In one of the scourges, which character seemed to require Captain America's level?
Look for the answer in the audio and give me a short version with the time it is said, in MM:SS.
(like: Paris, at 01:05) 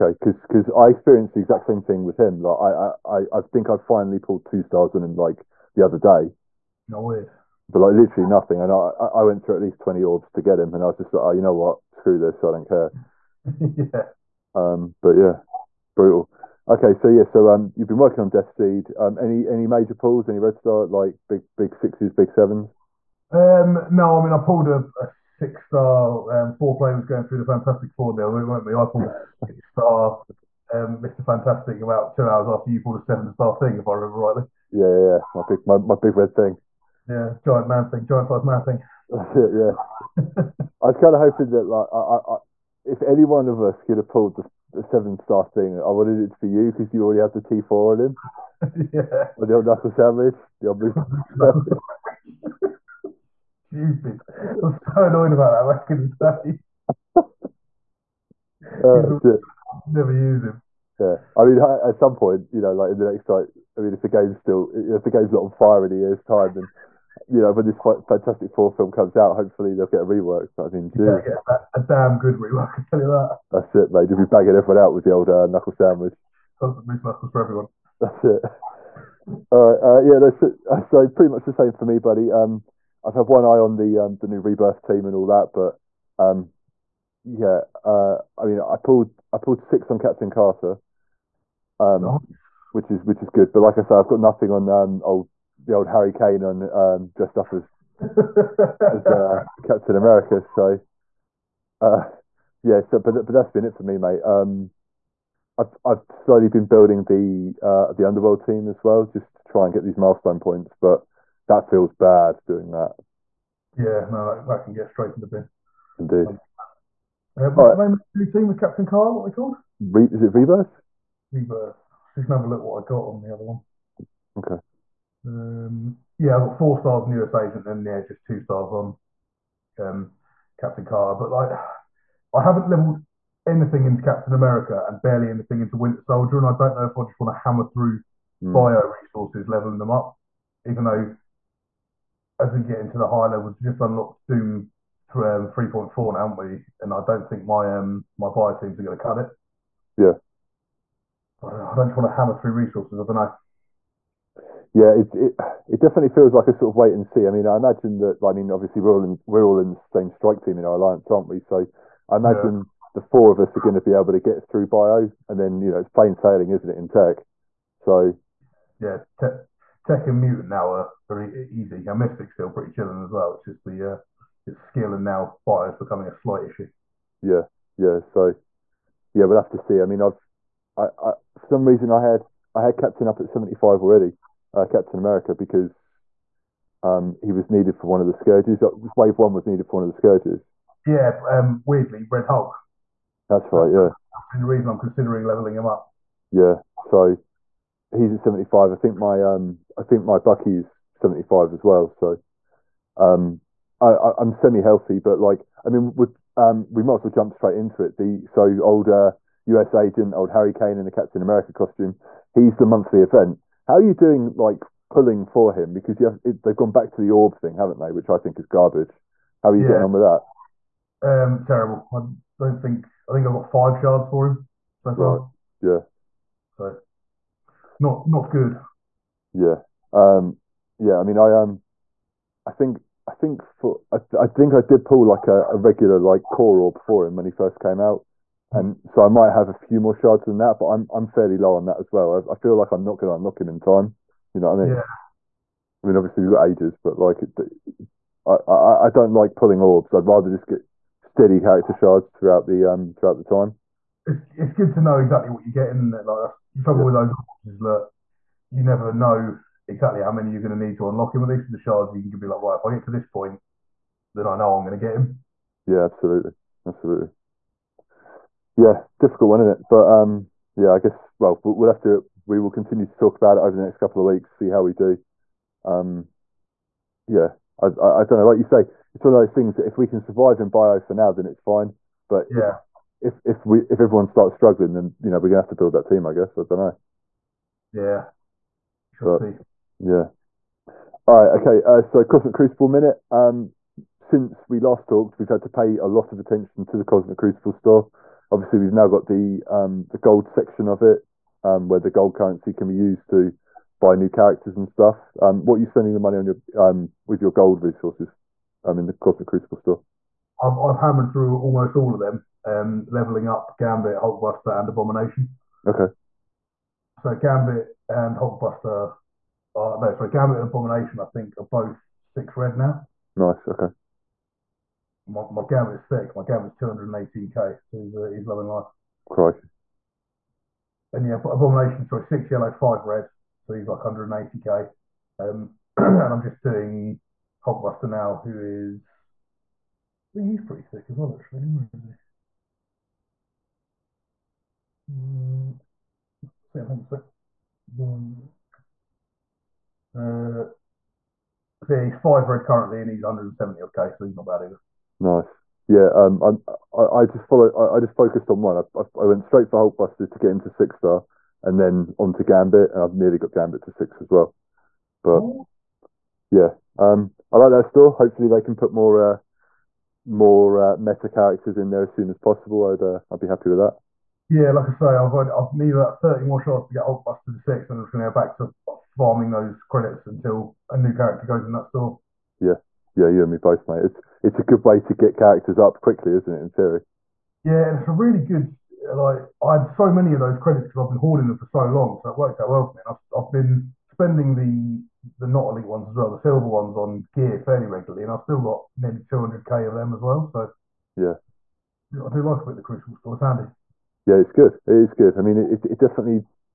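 Red Hulk, at 03:12.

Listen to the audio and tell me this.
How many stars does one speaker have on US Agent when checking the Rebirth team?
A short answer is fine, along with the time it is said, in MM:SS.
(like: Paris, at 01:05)
4, at 02:06.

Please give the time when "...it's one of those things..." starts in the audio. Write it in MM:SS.
04:38.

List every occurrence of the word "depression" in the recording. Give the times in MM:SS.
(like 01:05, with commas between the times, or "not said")
not said.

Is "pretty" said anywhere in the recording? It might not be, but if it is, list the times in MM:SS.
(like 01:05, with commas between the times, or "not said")
01:21, 02:52, 05:40.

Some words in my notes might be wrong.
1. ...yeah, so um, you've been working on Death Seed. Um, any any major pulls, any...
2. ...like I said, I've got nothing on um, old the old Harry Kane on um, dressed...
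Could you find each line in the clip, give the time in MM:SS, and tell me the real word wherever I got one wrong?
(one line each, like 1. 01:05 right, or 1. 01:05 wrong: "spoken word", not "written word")
1. 00:17 right
2. 01:33 right.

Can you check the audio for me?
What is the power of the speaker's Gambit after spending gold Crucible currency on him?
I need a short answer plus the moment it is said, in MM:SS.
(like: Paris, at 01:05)
218k, at 05:26.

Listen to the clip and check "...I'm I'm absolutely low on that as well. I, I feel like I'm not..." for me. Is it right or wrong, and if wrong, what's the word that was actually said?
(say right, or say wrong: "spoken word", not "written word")
wrong: "fairly", not "absolutely".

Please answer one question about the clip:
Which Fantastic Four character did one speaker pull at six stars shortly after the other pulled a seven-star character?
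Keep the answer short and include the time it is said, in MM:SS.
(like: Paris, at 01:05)
Mr. Fantastic, at 00:31.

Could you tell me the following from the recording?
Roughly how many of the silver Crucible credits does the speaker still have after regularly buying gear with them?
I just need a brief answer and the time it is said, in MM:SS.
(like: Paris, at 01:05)
200k, at 06:38.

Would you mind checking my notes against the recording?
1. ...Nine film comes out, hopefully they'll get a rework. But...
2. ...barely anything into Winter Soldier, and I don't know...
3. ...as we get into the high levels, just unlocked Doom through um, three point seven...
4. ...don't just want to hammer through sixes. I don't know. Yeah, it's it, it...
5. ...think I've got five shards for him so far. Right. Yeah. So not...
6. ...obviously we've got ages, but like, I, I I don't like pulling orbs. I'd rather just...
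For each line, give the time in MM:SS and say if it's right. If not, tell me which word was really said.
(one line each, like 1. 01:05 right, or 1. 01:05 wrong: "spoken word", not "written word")
1. 01:08 wrong: "Four", not "Nine"
2. 02:15 right
3. 02:22 wrong: "four", not "seven"
4. 02:31 wrong: "resources", not "sixes"
5. 03:43 right
6. 04:05 right.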